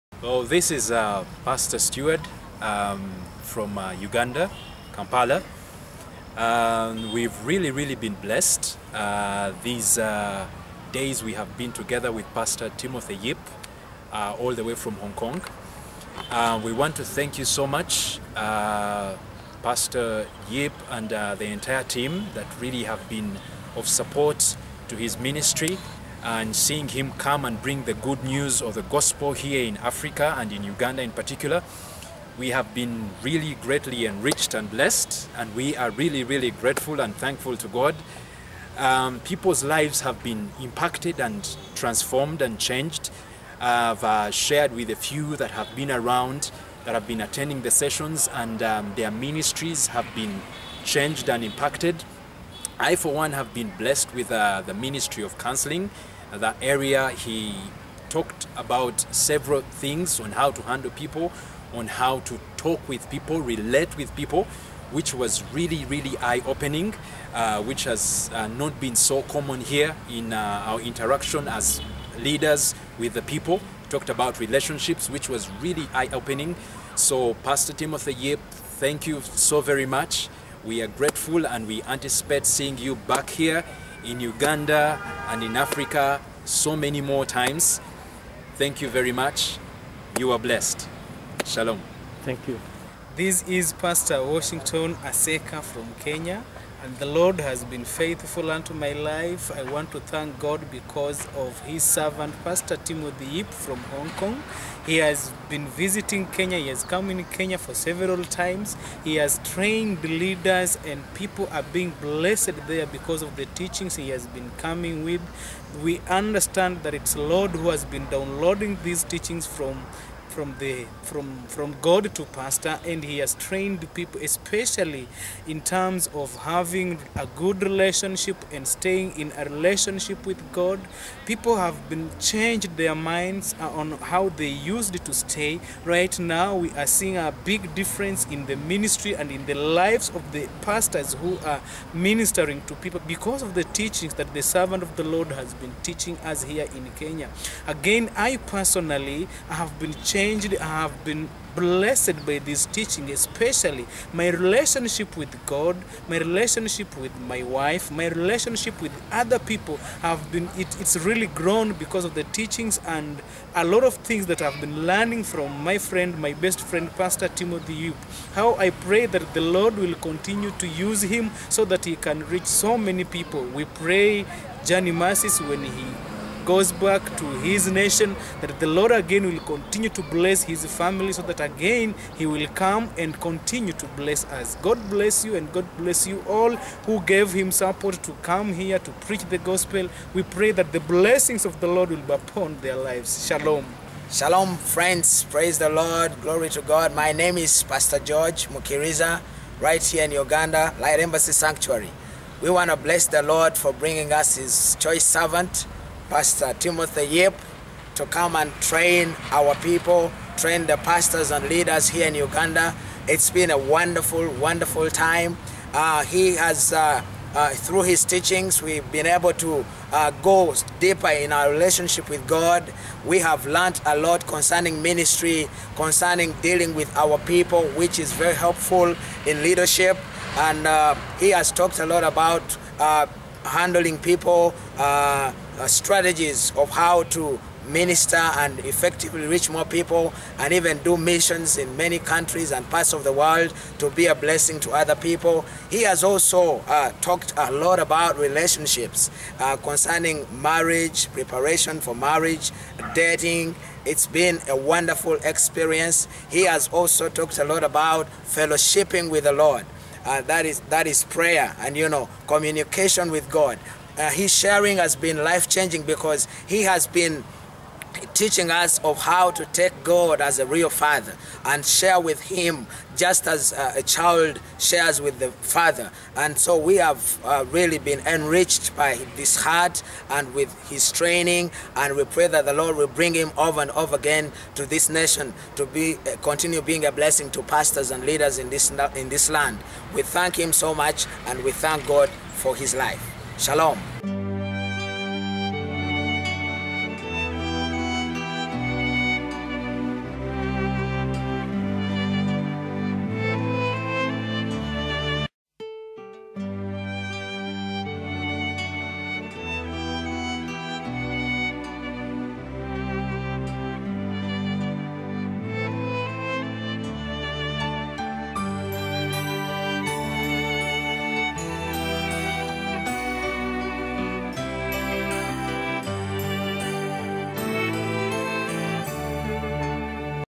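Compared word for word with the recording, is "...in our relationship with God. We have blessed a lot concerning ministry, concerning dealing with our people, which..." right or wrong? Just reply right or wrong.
wrong.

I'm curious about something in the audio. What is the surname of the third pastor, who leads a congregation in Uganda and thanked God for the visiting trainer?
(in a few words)
Mukiriza.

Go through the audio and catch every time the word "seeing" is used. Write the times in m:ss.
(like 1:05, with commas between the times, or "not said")
0:26, 1:22, 2:16.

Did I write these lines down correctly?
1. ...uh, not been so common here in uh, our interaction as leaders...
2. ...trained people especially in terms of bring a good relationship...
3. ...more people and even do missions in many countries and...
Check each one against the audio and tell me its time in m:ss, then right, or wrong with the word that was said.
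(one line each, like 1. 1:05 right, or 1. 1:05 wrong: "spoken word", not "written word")
1. 1:08 right
2. 2:03 wrong: "having", not "bring"
3. 3:59 right.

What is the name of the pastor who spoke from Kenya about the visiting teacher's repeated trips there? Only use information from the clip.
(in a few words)
Washington Aseka.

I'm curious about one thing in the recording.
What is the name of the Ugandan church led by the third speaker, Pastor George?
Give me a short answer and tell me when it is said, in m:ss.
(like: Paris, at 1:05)
Light Embassy Sanctuary, at 3:20.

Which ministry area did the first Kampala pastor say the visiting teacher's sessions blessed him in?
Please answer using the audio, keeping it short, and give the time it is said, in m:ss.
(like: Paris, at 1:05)
Counseling, at 0:54.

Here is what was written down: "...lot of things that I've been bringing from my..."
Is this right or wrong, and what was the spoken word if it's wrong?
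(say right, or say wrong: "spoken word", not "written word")
wrong: "learning", not "bringing".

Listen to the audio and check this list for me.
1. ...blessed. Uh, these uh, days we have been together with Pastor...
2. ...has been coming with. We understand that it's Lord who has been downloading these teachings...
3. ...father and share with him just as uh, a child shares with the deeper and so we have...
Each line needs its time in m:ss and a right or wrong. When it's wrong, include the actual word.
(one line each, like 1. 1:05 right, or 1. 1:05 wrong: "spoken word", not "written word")
1. 0:08 right
2. 1:54 right
3. 4:30 wrong: "father", not "deeper".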